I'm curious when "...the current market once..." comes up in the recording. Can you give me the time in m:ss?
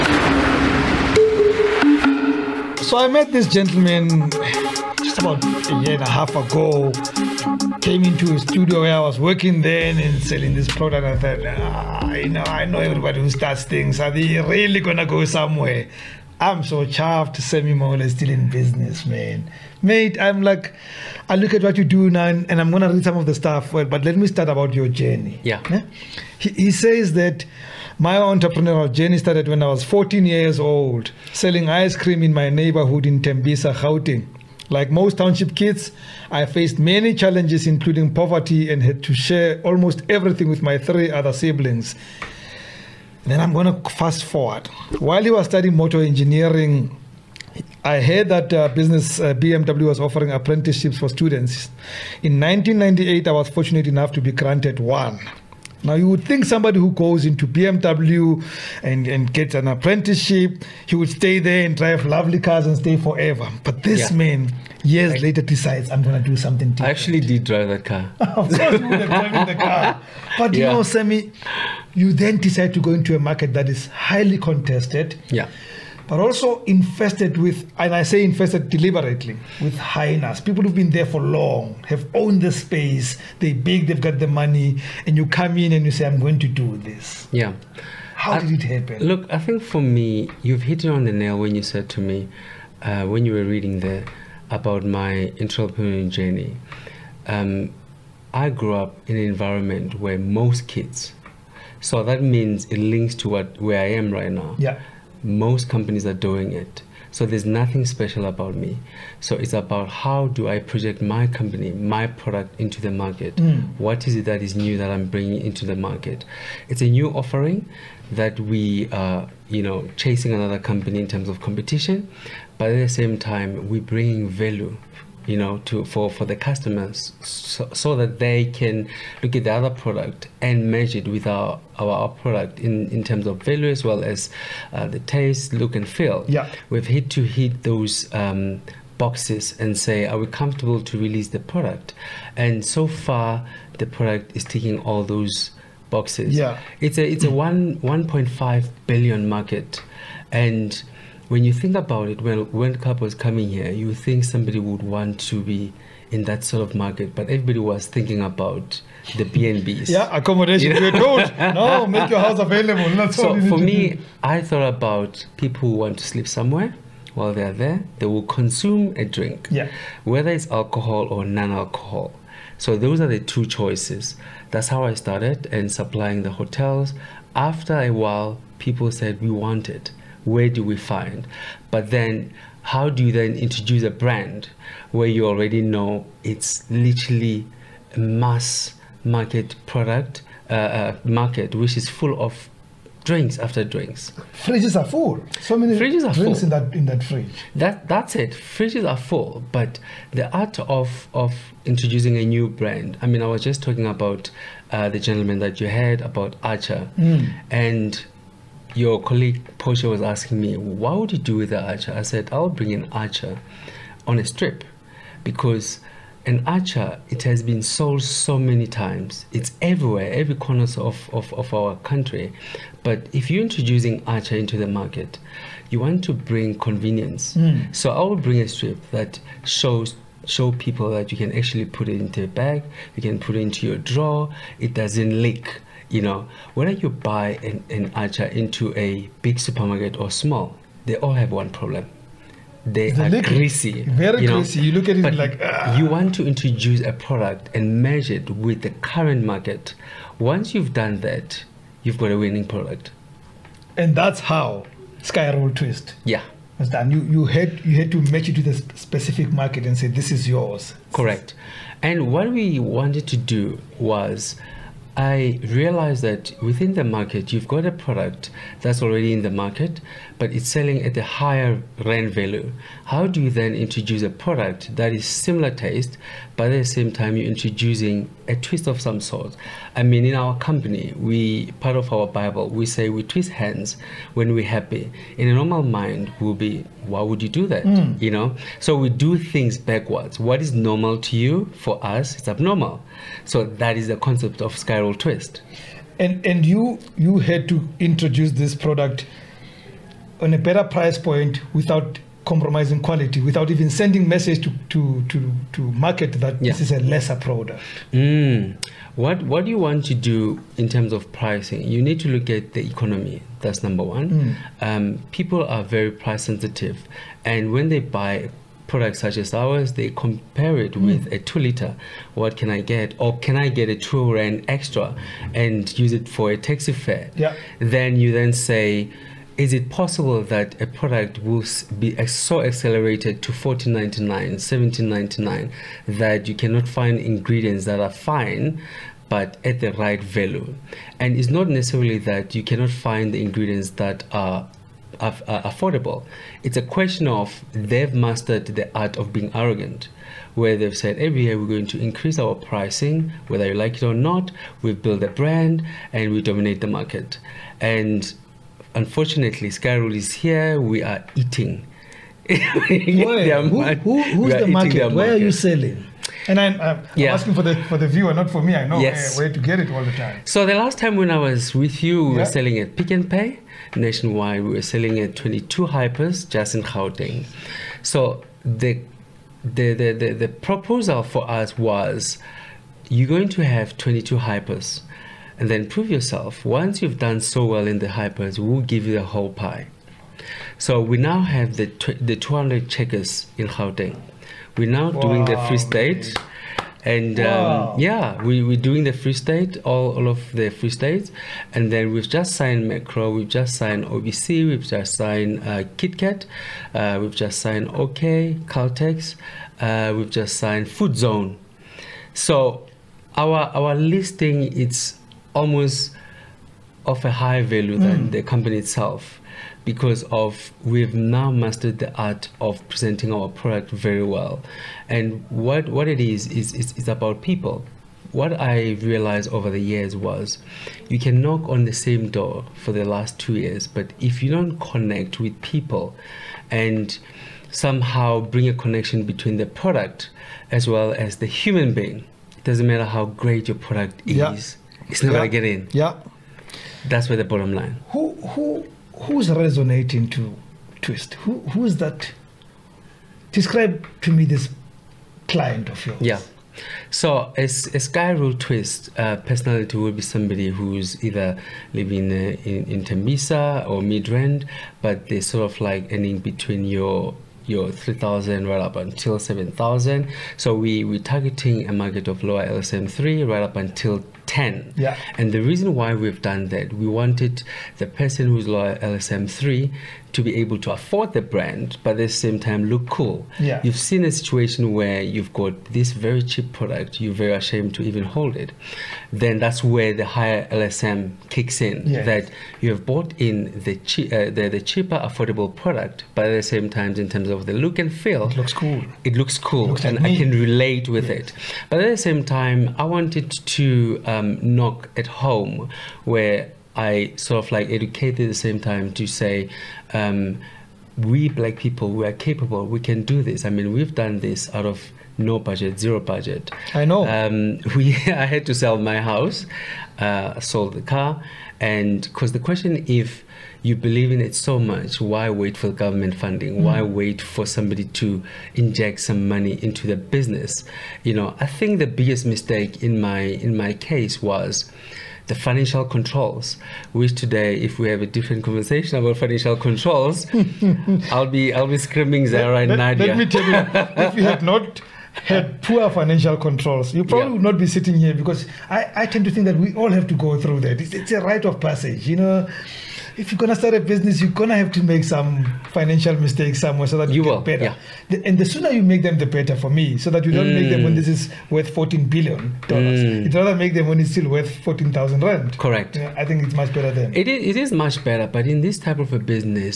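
4:08.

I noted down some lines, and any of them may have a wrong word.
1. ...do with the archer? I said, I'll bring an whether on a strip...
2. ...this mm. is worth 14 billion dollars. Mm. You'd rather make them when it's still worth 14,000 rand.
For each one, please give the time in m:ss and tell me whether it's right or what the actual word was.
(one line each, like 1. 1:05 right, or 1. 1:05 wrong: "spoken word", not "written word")
1. 3:31 wrong: "archer", not "whether"
2. 9:20 right.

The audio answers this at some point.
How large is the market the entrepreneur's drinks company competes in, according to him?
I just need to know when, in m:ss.
2:27.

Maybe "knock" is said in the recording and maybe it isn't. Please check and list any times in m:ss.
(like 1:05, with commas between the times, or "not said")
7:11, 8:24.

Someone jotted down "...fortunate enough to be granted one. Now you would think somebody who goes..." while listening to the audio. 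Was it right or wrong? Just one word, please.
right.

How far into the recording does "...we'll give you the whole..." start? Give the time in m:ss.
6:28.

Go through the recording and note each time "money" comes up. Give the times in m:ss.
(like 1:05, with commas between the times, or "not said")
1:24, 8:49.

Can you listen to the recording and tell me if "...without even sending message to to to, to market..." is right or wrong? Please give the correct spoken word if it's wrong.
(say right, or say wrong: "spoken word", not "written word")
right.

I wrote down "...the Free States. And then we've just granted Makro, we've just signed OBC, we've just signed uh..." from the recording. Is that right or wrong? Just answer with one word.
wrong.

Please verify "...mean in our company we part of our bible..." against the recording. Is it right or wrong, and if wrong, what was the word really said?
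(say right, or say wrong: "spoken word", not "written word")
right.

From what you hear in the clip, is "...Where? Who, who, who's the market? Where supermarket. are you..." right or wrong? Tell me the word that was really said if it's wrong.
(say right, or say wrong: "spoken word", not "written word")
wrong: "market", not "supermarket".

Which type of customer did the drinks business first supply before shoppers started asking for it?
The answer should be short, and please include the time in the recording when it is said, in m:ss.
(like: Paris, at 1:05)
Hotels, at 2:56.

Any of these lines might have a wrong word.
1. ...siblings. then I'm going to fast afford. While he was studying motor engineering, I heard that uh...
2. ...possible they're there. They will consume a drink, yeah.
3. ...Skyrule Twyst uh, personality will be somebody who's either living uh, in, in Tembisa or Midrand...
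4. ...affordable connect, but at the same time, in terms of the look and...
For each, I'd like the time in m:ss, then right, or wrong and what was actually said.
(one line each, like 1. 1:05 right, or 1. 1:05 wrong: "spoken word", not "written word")
1. 0:41 wrong: "forward", not "afford"
2. 2:47 wrong: "while", not "possible"
3. 7:37 right
4. 8:14 wrong: "product", not "connect".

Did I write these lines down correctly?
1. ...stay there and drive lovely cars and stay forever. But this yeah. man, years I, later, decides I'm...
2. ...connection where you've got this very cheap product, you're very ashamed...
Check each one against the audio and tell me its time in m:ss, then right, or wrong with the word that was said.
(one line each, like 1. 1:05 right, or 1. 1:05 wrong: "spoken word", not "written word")
1. 1:01 right
2. 8:04 wrong: "situation", not "connection".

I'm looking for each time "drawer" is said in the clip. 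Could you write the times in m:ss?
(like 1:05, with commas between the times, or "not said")
3:53.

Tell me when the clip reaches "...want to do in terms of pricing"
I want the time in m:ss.
5:09.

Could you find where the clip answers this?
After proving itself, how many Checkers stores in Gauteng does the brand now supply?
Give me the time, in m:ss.
6:32.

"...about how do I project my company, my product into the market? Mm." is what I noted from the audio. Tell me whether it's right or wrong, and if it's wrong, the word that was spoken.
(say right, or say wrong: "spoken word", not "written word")
right.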